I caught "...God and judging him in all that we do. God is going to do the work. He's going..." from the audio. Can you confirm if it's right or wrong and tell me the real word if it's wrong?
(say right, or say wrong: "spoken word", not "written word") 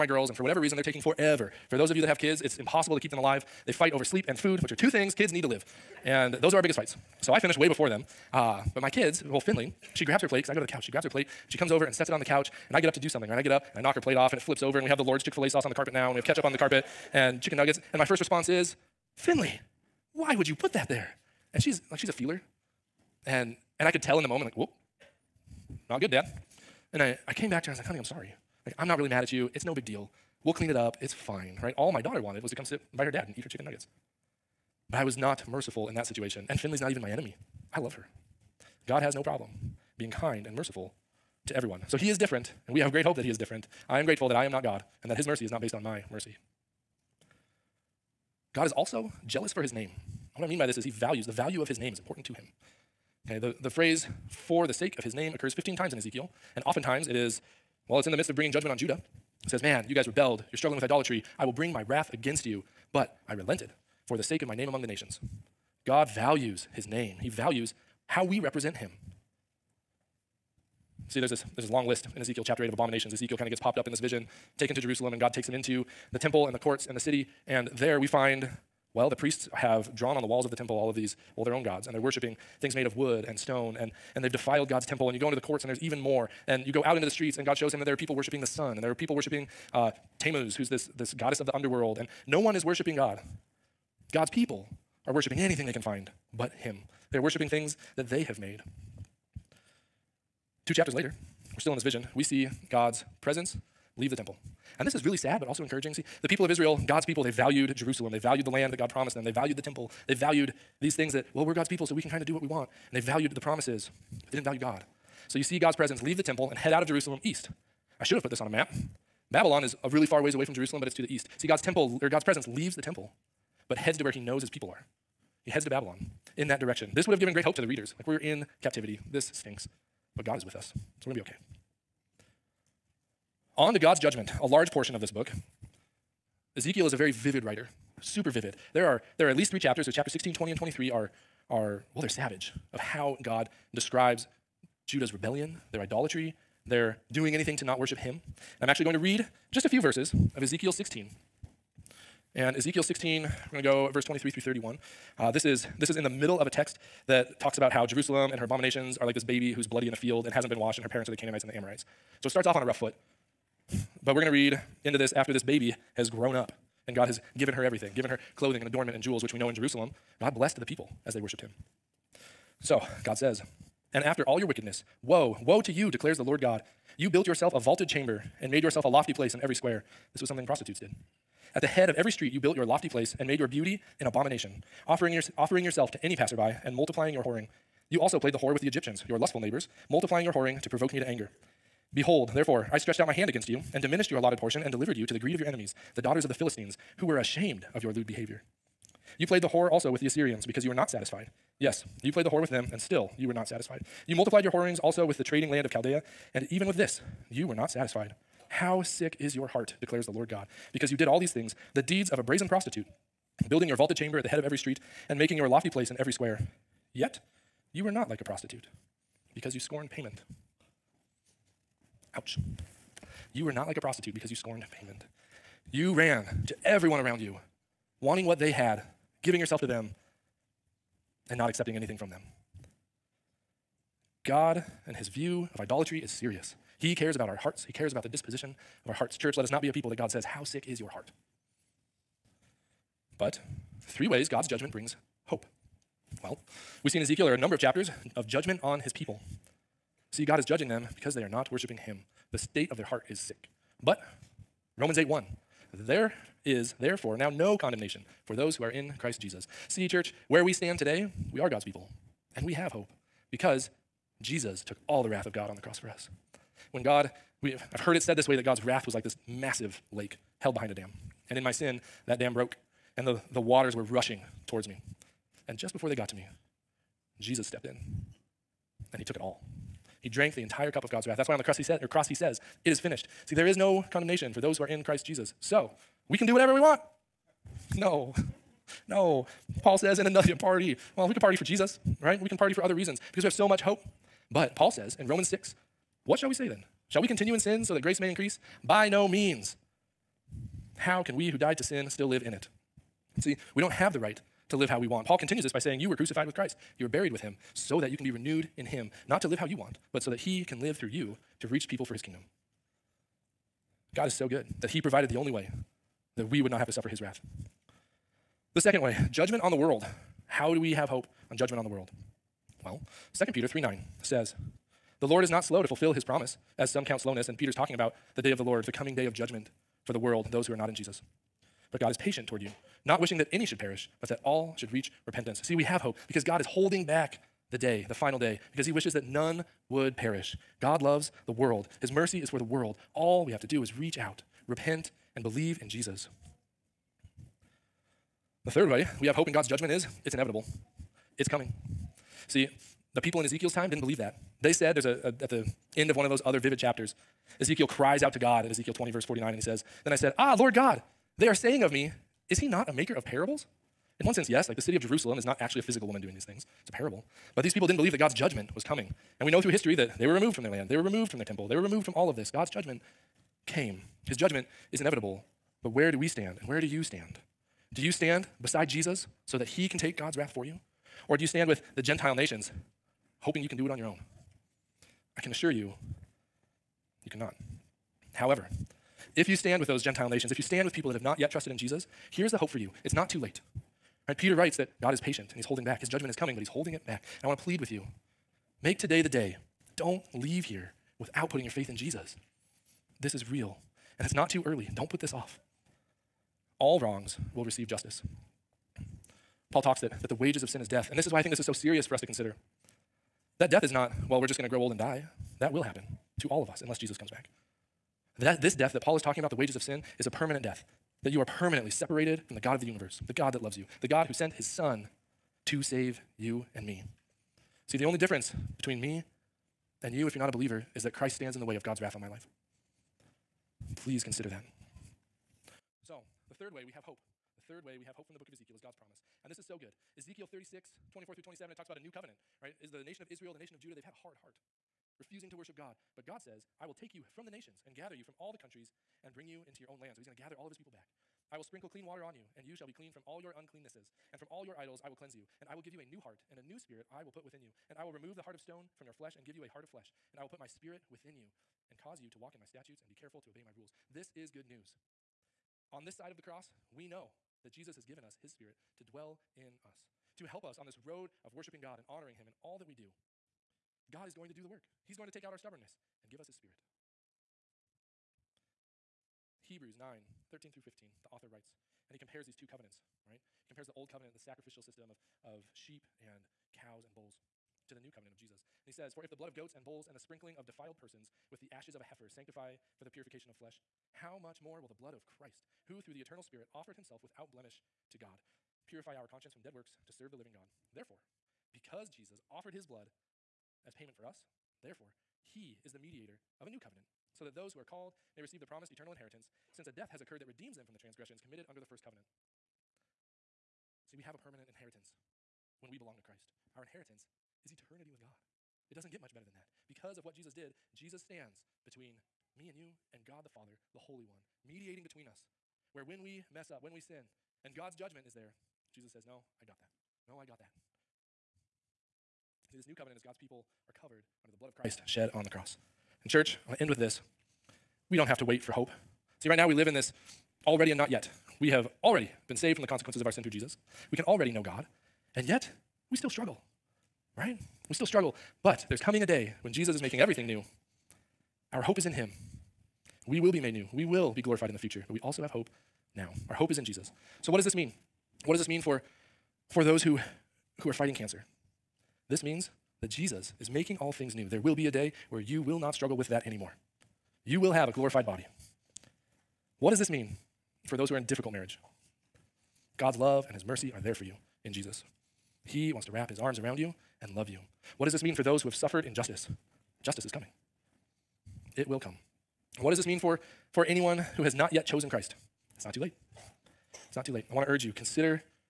wrong: "honoring", not "judging".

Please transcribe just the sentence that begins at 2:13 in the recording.
On to God's judgment, a large portion of this book.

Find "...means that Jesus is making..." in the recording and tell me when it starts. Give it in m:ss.
9:22.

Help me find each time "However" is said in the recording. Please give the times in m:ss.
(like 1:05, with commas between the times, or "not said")
6:28.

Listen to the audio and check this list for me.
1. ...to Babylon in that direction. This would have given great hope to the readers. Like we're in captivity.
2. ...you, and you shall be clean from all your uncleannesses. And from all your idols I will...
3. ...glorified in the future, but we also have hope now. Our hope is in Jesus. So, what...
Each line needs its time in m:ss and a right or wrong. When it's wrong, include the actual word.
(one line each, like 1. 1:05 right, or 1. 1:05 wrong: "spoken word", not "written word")
1. 2:05 right
2. 7:32 right
3. 9:14 right.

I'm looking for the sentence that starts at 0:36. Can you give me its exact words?
And Finley's not even my enemy.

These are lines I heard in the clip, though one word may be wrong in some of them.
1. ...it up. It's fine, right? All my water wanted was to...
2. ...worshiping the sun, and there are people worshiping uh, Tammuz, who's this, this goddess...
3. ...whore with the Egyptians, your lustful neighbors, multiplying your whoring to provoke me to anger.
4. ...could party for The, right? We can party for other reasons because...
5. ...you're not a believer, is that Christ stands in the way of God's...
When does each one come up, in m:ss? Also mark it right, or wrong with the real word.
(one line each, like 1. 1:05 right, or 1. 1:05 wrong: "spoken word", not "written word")
1. 0:30 wrong: "daughter", not "water"
2. 1:28 right
3. 3:08 right
4. 4:51 wrong: "Jesus", not "The"
5. 7:10 right.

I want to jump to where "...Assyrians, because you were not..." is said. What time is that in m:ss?
3:20.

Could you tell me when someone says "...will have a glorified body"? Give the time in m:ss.
9:27.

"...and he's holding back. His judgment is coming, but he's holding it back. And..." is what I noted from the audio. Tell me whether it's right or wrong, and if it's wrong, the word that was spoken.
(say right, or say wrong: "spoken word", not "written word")
right.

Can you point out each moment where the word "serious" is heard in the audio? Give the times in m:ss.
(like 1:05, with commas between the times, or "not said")
3:56, 6:51.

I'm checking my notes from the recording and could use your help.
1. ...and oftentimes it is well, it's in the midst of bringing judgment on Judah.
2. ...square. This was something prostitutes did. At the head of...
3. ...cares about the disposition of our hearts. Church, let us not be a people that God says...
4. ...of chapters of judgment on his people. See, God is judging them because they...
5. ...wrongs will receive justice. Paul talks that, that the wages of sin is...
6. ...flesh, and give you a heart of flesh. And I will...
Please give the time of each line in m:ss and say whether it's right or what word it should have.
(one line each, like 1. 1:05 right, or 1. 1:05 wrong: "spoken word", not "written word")
1. 0:56 right
2. 2:59 right
3. 3:57 right
4. 4:07 right
5. 6:46 right
6. 7:38 right.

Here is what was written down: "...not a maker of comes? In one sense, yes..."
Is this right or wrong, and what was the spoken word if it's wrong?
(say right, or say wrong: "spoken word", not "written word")
wrong: "parables", not "comes".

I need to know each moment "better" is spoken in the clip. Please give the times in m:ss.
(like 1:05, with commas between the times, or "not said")
8:39.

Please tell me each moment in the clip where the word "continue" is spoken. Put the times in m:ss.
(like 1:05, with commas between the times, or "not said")
4:57, 5:05.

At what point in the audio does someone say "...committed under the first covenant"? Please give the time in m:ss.
8:31.